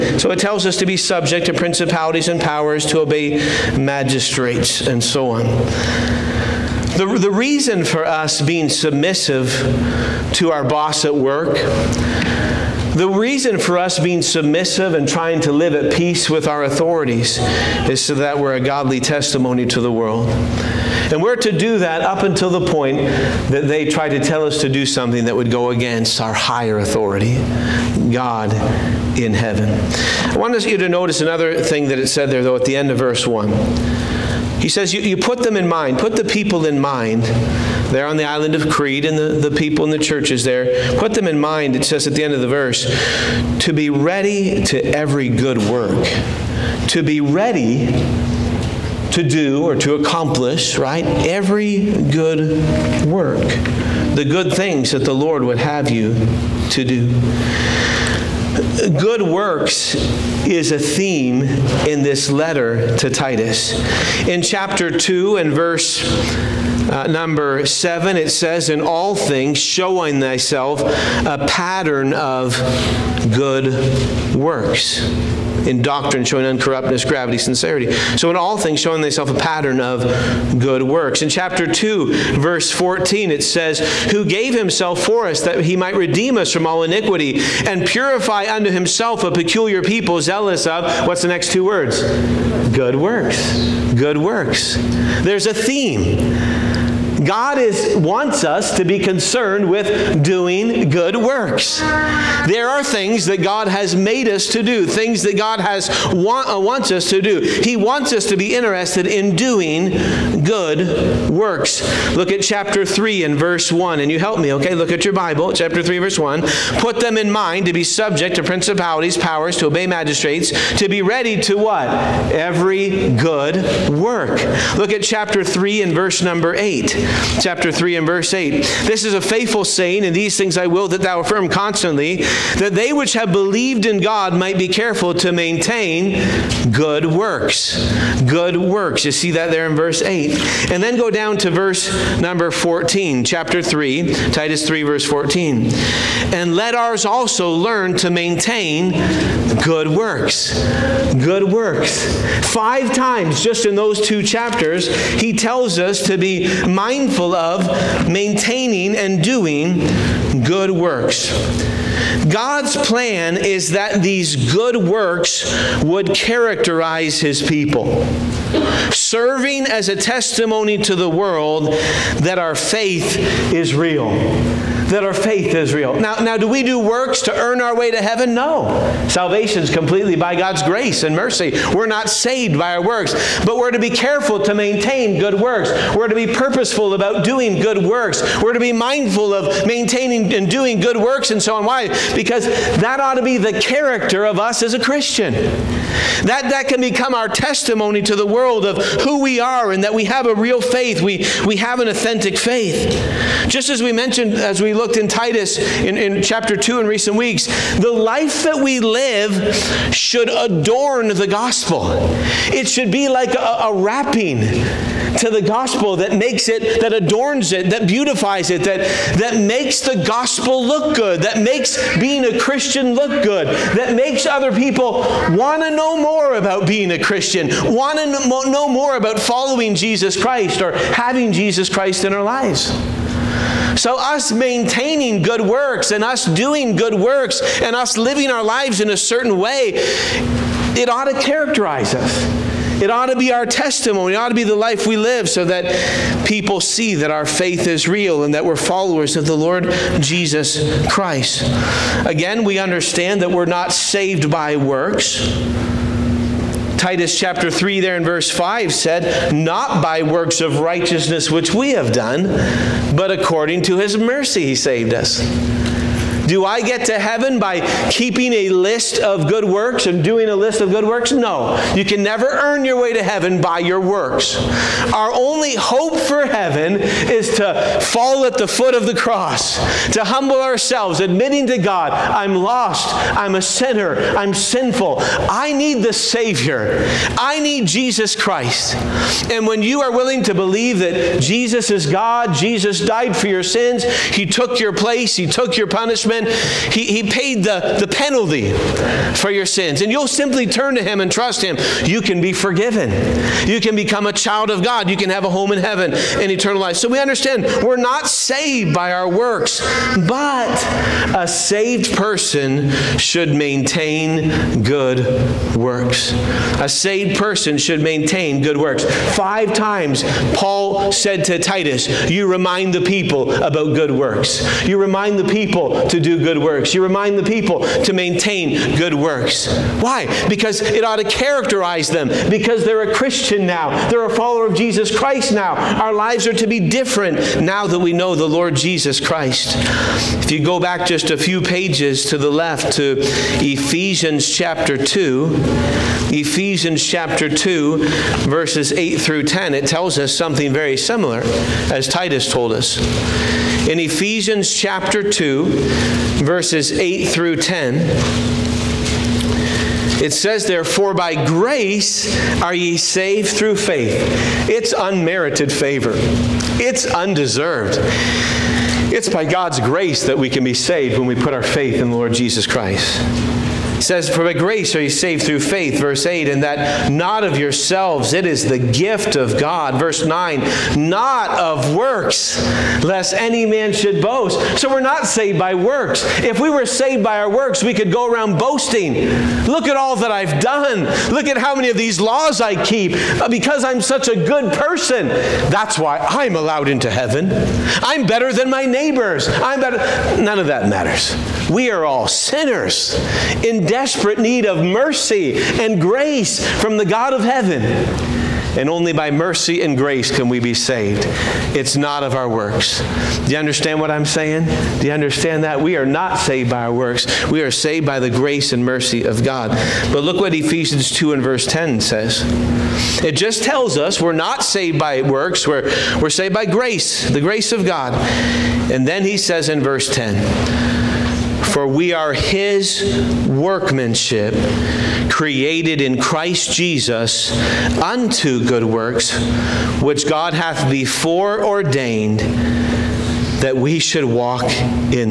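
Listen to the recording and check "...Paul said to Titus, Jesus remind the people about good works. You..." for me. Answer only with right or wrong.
wrong.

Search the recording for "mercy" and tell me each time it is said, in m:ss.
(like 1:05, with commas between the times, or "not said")
3:01, 4:23, 6:44, 6:49, 6:58.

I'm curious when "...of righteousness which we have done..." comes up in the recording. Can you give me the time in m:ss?
4:20.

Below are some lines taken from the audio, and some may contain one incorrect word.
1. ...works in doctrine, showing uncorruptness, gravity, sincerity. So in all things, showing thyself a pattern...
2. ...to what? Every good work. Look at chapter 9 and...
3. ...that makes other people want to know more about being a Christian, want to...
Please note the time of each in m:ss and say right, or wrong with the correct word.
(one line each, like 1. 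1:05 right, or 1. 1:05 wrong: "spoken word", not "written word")
1. 1:14 right
2. 2:01 wrong: "3", not "9"
3. 3:43 right.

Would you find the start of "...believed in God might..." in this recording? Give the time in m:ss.
2:13.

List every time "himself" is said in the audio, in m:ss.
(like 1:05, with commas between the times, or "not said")
1:24, 1:28.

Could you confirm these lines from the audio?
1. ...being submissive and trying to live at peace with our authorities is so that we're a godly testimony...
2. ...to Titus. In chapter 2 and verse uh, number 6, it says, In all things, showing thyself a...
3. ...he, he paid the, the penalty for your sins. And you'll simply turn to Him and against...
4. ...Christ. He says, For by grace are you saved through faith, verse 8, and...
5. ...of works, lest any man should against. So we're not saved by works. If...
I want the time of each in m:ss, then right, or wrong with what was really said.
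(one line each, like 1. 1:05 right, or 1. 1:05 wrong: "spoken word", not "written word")
1. 0:13 right
2. 1:02 wrong: "7", not "6"
3. 4:56 wrong: "trust", not "against"
4. 6:12 right
5. 6:21 wrong: "boast", not "against".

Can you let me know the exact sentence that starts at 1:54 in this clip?
Look at your Bible, chapter 3, verse 1.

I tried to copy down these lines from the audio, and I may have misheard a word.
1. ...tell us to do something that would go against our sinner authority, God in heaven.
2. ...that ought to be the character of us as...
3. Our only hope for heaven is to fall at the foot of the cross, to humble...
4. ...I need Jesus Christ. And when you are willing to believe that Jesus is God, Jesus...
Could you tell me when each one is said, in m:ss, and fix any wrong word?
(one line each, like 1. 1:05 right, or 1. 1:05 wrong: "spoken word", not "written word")
1. 0:24 wrong: "higher", not "sinner"
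2. 3:12 right
3. 4:34 right
4. 4:47 right.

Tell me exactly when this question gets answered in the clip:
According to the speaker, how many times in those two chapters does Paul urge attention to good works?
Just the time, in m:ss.
2:32.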